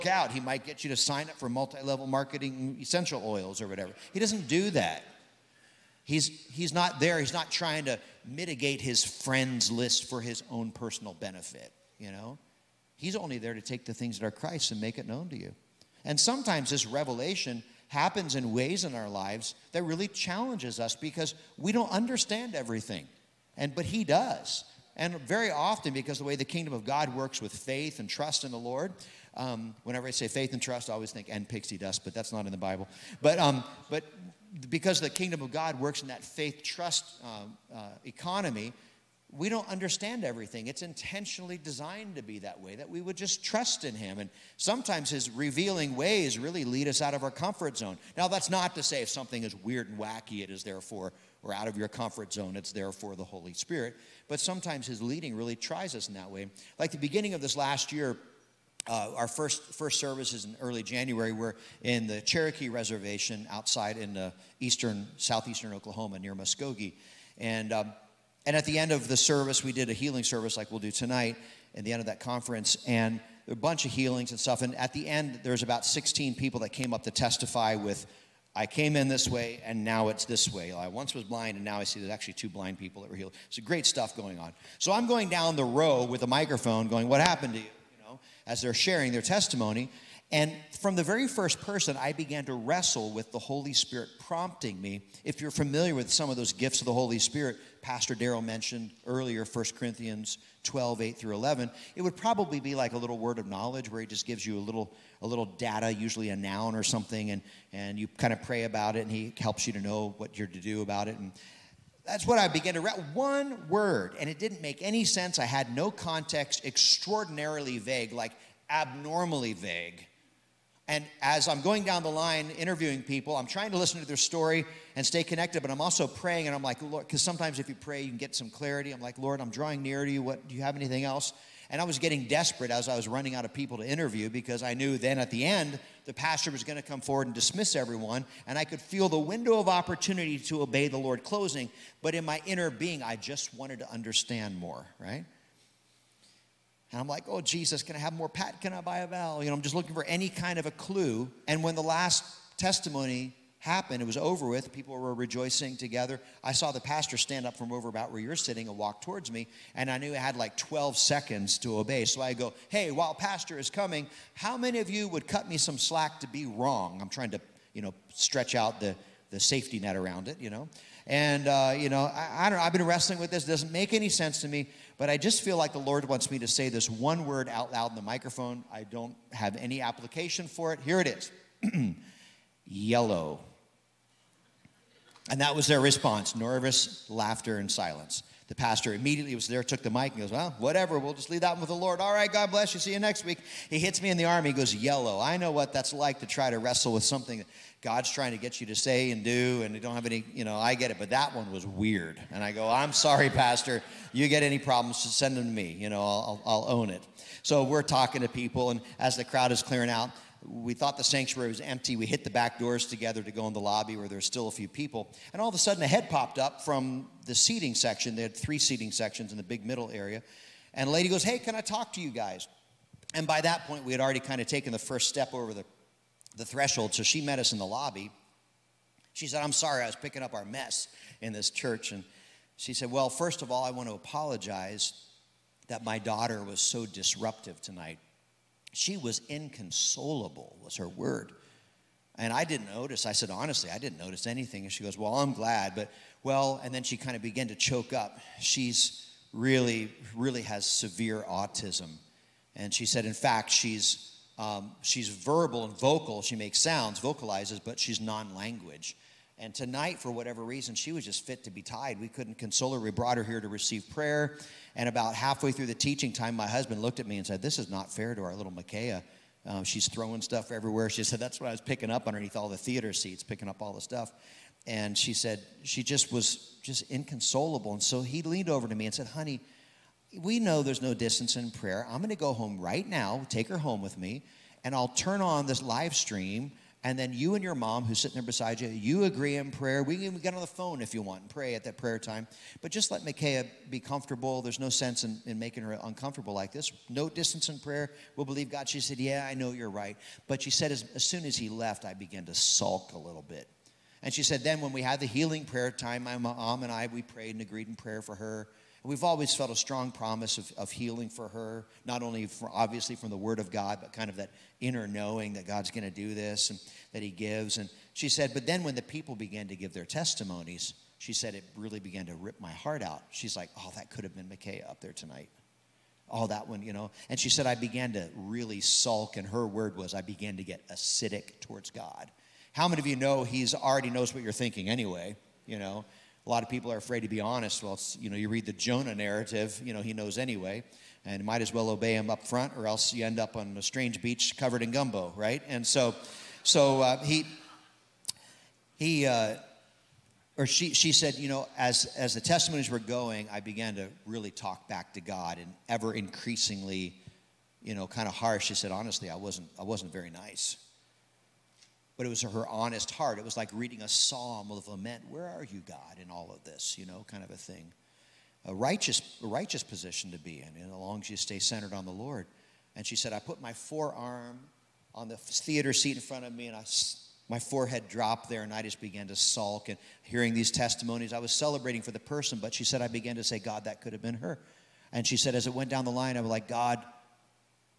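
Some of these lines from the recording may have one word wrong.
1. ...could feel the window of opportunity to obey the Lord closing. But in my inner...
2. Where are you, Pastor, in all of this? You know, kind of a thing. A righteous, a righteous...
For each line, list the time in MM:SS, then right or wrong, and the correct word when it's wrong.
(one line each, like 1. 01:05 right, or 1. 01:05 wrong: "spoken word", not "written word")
1. 02:18 right
2. 06:05 wrong: "God", not "Pastor".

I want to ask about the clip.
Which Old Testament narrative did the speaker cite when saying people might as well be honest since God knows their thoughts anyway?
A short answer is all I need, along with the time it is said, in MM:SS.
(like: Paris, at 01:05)
Jonah, at 05:38.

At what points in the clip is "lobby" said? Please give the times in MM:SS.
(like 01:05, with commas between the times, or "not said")
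03:33, 03:47.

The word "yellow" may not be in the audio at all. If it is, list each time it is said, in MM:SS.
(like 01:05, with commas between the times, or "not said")
03:02, 03:14.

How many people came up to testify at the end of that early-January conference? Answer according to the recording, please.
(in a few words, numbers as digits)
16.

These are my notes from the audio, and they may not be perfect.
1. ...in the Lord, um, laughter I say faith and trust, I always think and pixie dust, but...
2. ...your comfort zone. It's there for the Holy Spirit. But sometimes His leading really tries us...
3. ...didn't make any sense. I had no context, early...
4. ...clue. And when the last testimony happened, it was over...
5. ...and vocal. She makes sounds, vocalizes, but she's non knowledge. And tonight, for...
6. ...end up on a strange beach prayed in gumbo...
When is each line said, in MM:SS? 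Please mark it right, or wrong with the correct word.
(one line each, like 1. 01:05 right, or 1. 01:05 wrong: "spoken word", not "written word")
1. 00:28 wrong: "whenever", not "laughter"
2. 00:51 right
3. 01:54 wrong: "extraordinarily", not "early"
4. 02:30 right
5. 04:15 wrong: "language", not "knowledge"
6. 05:43 wrong: "covered", not "prayed".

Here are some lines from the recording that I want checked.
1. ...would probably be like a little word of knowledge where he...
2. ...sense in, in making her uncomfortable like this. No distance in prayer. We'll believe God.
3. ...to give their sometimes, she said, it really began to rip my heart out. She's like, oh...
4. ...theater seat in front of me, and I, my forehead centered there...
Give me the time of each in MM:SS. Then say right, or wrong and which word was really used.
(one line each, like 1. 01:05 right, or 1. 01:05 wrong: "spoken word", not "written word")
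1. 01:42 right
2. 04:54 right
3. 05:19 wrong: "testimonies", not "sometimes"
4. 06:15 wrong: "dropped", not "centered".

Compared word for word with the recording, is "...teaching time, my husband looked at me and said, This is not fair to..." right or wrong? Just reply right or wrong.
right.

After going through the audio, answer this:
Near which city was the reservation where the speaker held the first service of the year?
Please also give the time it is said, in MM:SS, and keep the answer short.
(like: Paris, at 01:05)
Muskogee, at 01:06.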